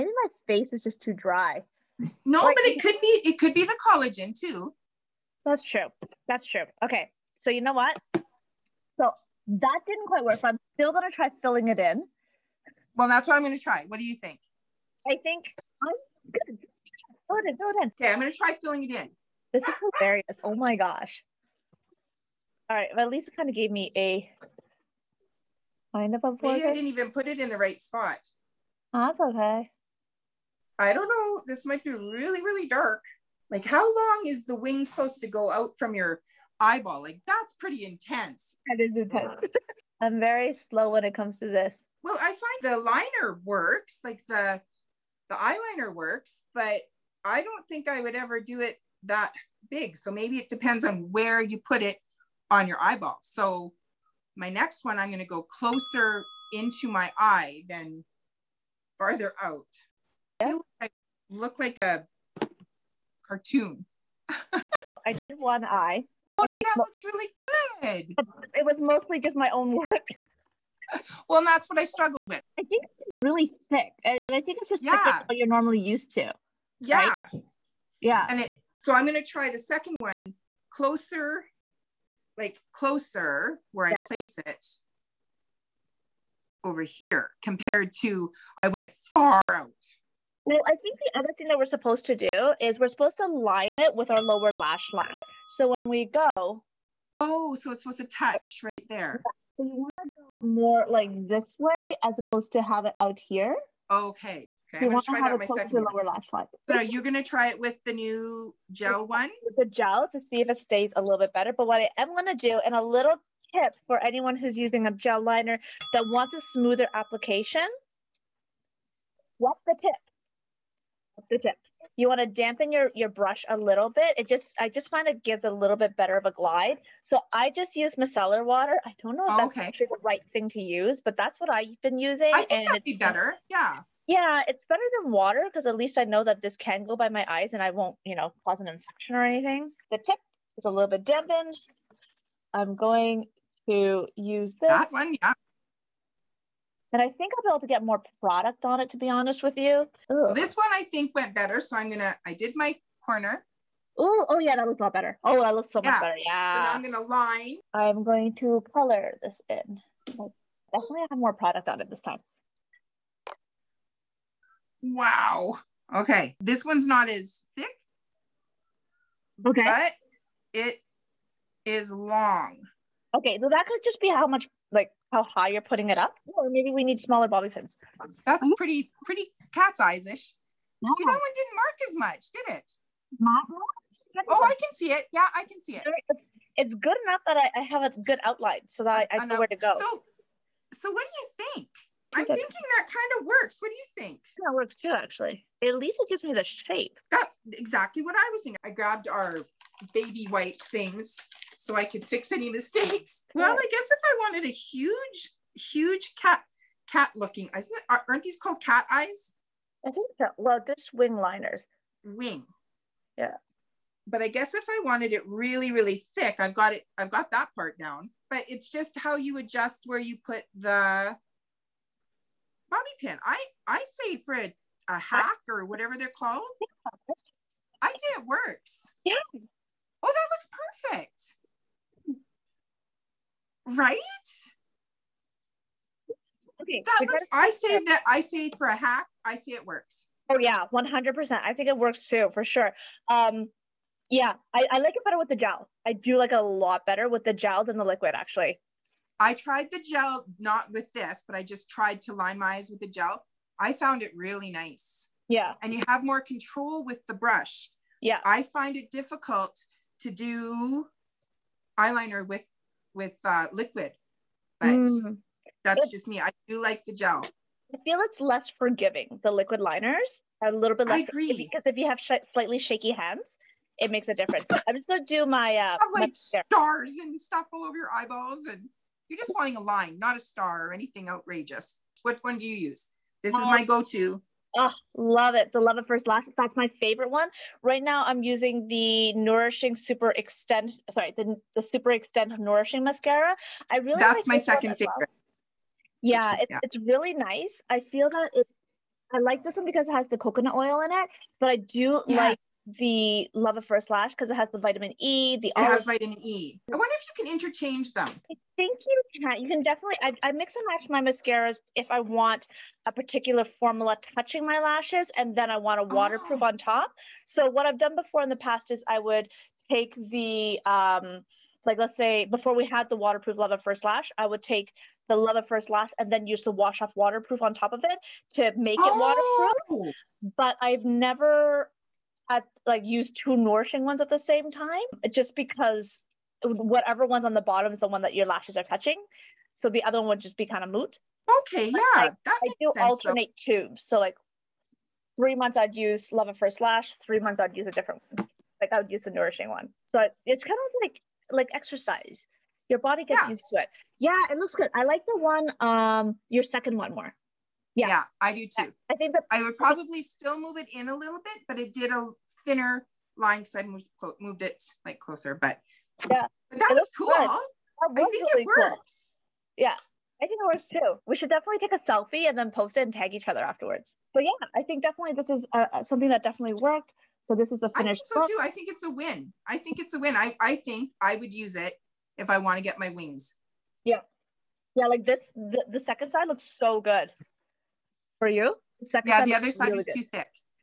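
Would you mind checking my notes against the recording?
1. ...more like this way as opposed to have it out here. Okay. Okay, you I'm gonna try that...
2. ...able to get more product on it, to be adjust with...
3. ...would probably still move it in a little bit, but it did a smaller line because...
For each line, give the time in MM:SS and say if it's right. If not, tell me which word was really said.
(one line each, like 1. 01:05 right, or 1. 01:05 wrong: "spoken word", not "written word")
1. 01:40 right
2. 02:27 wrong: "honest", not "adjust"
3. 05:59 wrong: "thinner", not "smaller".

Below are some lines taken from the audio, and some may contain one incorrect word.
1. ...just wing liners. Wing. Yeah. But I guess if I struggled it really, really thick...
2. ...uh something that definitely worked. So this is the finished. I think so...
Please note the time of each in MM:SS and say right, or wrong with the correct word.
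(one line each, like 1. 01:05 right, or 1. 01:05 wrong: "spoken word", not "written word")
1. 03:30 wrong: "wanted", not "struggled"
2. 06:15 right.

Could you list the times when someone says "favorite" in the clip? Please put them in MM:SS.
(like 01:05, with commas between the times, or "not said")
04:46, 04:54.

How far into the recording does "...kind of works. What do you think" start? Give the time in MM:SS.
03:12.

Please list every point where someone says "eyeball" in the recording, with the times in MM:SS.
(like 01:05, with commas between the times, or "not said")
00:36, 00:52, 04:37.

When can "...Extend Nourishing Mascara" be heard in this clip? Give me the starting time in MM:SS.
04:51.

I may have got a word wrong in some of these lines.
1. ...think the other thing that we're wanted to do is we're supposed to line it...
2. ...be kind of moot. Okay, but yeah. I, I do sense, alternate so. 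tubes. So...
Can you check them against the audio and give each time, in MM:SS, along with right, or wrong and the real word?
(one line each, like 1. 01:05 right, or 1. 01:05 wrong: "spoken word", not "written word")
1. 01:30 wrong: "supposed", not "wanted"
2. 05:40 right.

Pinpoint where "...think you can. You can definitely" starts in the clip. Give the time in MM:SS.
05:08.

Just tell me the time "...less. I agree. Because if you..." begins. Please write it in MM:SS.
04:30.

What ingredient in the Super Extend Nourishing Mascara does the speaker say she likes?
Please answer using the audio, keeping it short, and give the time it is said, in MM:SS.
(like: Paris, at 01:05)
coconut oil, at 05:00.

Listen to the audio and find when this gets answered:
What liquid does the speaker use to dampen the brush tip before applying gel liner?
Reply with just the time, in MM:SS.
02:07.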